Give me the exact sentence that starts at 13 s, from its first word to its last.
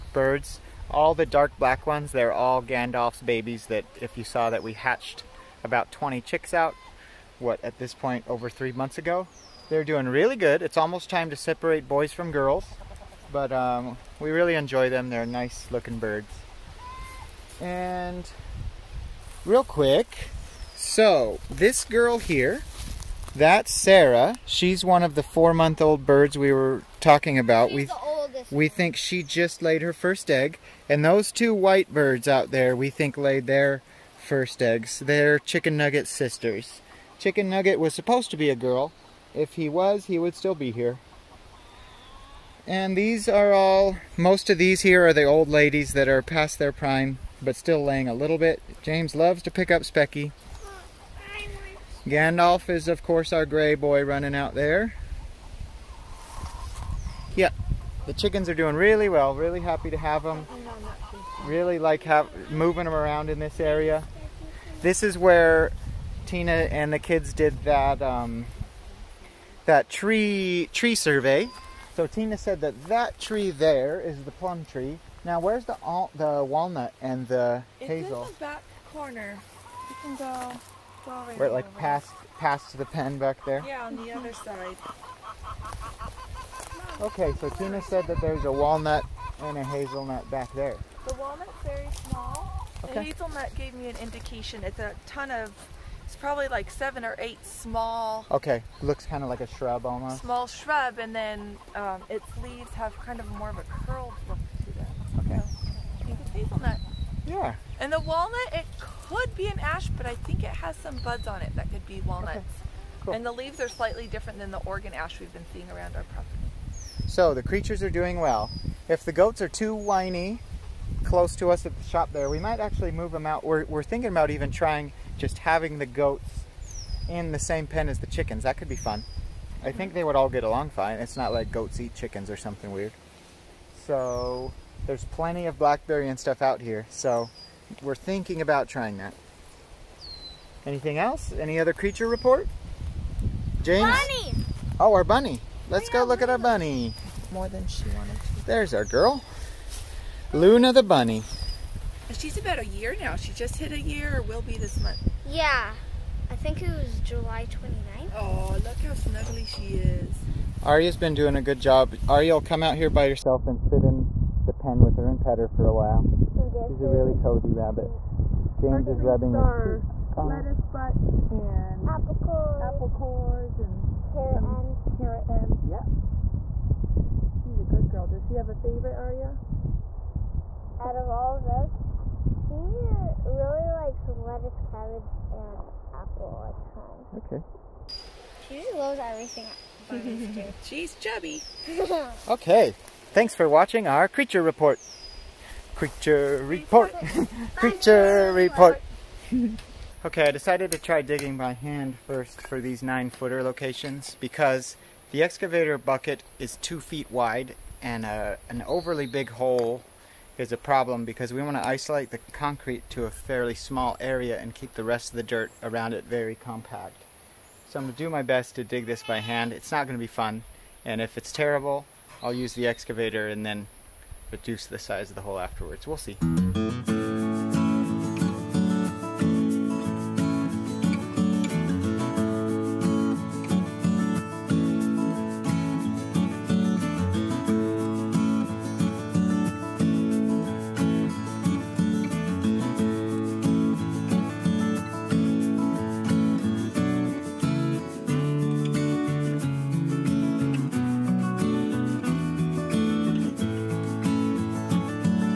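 But um, we really enjoy them.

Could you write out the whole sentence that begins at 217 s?
So I'm going to do my best to dig this by hand.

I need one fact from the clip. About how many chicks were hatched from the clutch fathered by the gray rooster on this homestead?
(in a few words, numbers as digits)
20.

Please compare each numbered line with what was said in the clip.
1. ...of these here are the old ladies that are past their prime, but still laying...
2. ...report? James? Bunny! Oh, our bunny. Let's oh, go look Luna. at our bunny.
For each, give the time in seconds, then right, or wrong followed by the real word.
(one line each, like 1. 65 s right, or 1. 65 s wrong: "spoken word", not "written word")
1. 44 s right
2. 142 s right.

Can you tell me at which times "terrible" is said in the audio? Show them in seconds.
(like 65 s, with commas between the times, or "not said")
221 s.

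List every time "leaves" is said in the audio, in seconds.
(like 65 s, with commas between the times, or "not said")
102 s, 113 s.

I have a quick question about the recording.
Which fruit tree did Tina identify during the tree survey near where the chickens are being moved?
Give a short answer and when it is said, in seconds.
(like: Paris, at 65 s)
plum tree, at 74 s.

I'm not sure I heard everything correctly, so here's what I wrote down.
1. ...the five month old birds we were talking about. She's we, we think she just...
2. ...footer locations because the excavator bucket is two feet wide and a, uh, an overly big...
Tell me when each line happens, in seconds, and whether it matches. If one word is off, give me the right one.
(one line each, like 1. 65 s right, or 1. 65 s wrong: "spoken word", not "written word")
1. 25 s wrong: "four", not "five"
2. 203 s right.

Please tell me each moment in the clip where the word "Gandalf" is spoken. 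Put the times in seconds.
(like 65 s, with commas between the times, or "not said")
2 s, 52 s.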